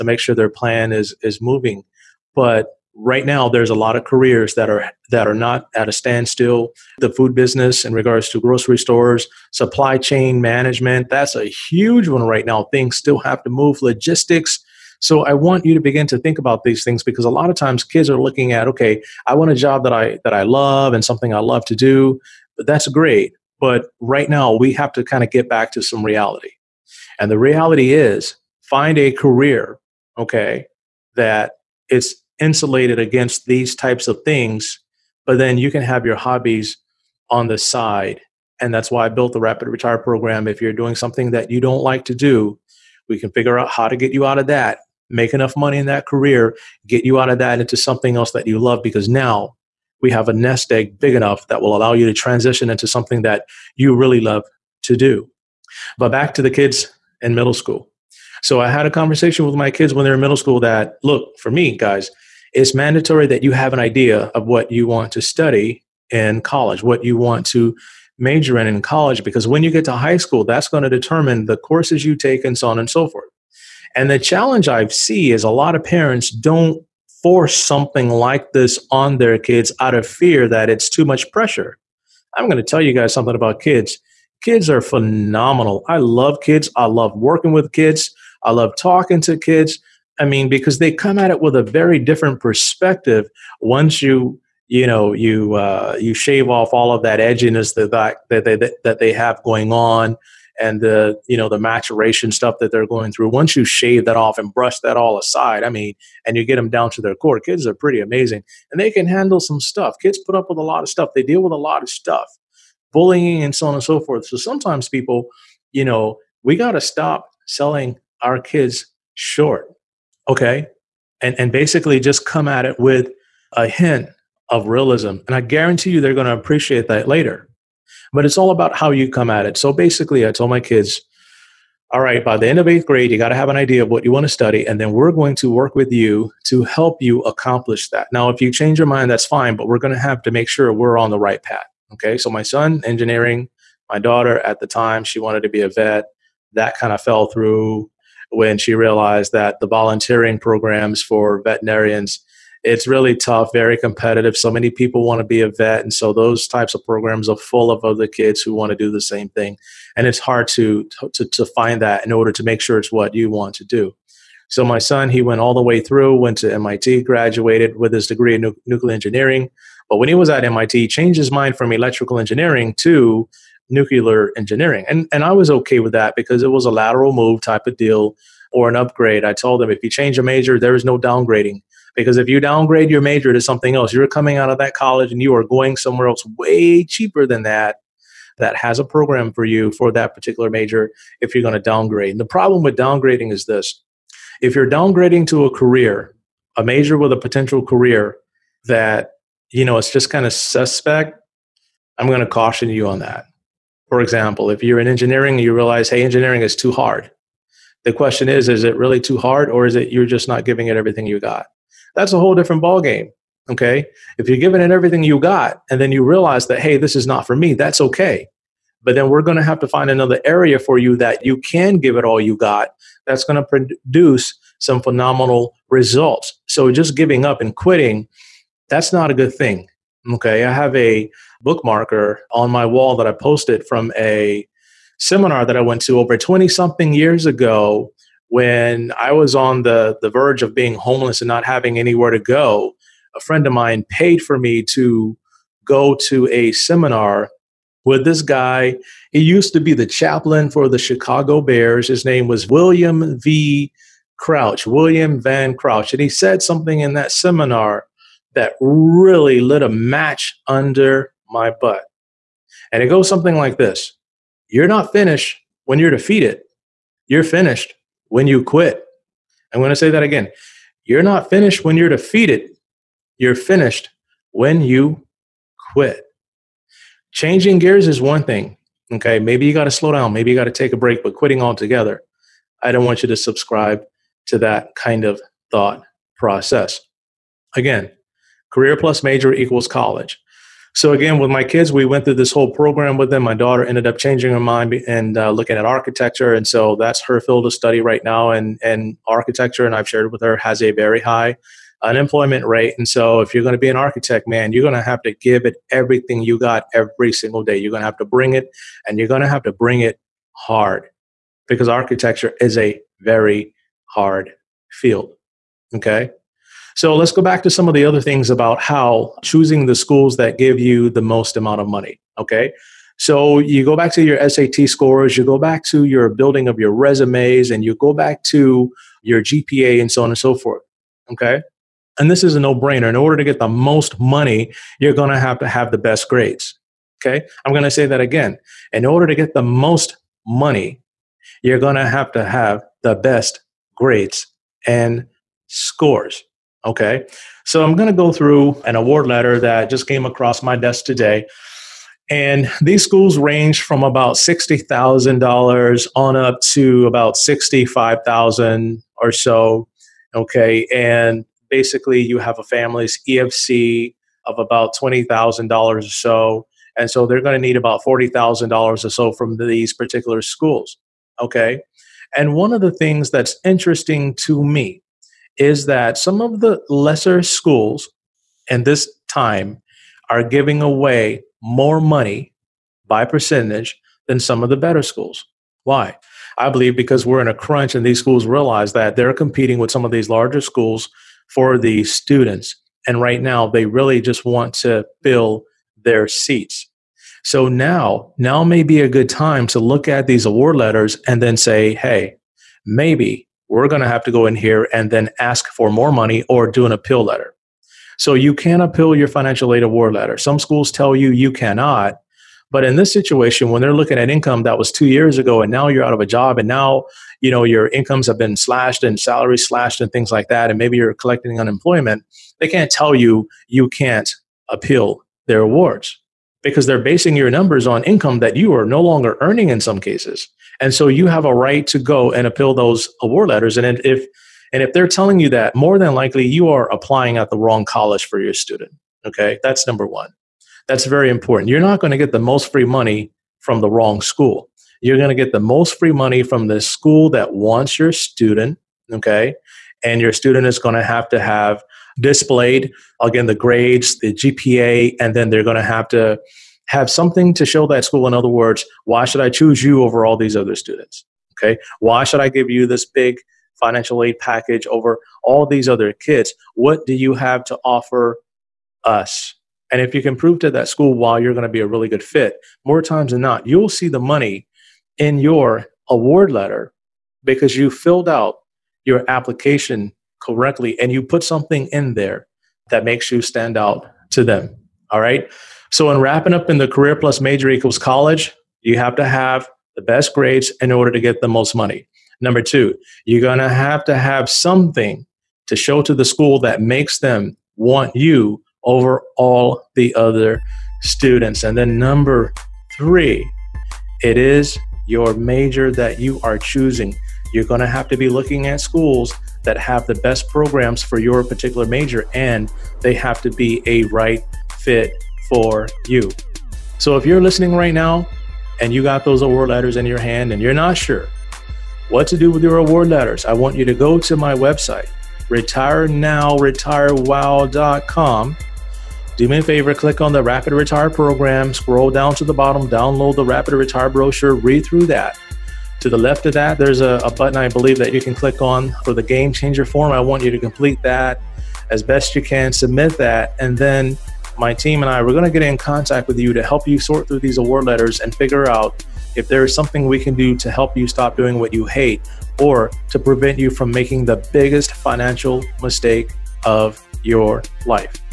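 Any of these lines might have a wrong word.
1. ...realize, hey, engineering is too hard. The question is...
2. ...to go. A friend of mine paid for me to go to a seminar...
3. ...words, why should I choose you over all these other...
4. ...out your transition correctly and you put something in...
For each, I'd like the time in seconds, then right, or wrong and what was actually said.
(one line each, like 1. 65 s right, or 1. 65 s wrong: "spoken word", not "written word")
1. 205 s right
2. 242 s right
3. 458 s right
4. 478 s wrong: "application", not "transition".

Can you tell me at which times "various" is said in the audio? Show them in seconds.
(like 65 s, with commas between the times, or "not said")
not said.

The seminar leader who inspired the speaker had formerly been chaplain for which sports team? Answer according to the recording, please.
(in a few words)
Chicago Bears.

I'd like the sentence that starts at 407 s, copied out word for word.
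So you can appeal your financial aid award letter.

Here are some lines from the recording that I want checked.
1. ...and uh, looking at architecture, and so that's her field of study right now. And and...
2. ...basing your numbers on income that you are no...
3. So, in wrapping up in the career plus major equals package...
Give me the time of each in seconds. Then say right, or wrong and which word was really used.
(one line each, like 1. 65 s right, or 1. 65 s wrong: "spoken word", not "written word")
1. 294 s right
2. 426 s right
3. 485 s wrong: "college", not "package".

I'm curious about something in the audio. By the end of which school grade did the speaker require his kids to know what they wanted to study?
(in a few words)
Eighth grade.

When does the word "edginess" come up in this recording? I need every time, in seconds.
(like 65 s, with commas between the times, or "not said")
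97 s.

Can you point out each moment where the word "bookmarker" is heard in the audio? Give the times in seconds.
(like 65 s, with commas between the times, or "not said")
231 s.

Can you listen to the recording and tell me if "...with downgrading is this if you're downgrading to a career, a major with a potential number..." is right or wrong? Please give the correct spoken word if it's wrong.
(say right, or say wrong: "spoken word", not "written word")
wrong: "career", not "number".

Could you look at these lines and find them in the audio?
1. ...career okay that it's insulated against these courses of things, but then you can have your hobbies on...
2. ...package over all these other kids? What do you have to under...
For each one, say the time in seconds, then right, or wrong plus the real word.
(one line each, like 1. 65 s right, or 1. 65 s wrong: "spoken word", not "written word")
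1. 29 s wrong: "types", not "courses"
2. 464 s wrong: "offer", not "under".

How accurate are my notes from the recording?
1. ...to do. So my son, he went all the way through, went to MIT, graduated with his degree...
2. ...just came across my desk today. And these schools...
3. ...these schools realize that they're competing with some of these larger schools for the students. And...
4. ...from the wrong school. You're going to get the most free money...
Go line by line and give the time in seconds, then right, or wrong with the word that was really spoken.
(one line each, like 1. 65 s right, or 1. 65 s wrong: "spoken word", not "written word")
1. 163 s right
2. 349 s right
3. 387 s right
4. 443 s right.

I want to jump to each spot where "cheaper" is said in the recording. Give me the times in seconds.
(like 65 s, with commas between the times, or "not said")
186 s.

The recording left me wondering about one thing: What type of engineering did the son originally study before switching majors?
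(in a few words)
Electrical engineering.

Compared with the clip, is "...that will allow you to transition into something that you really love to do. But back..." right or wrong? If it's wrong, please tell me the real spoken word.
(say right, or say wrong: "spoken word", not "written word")
right.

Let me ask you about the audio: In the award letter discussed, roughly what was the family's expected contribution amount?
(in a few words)
$20,000.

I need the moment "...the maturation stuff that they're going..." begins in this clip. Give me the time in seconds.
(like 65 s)
101 s.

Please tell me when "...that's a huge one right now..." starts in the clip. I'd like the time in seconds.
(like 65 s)
11 s.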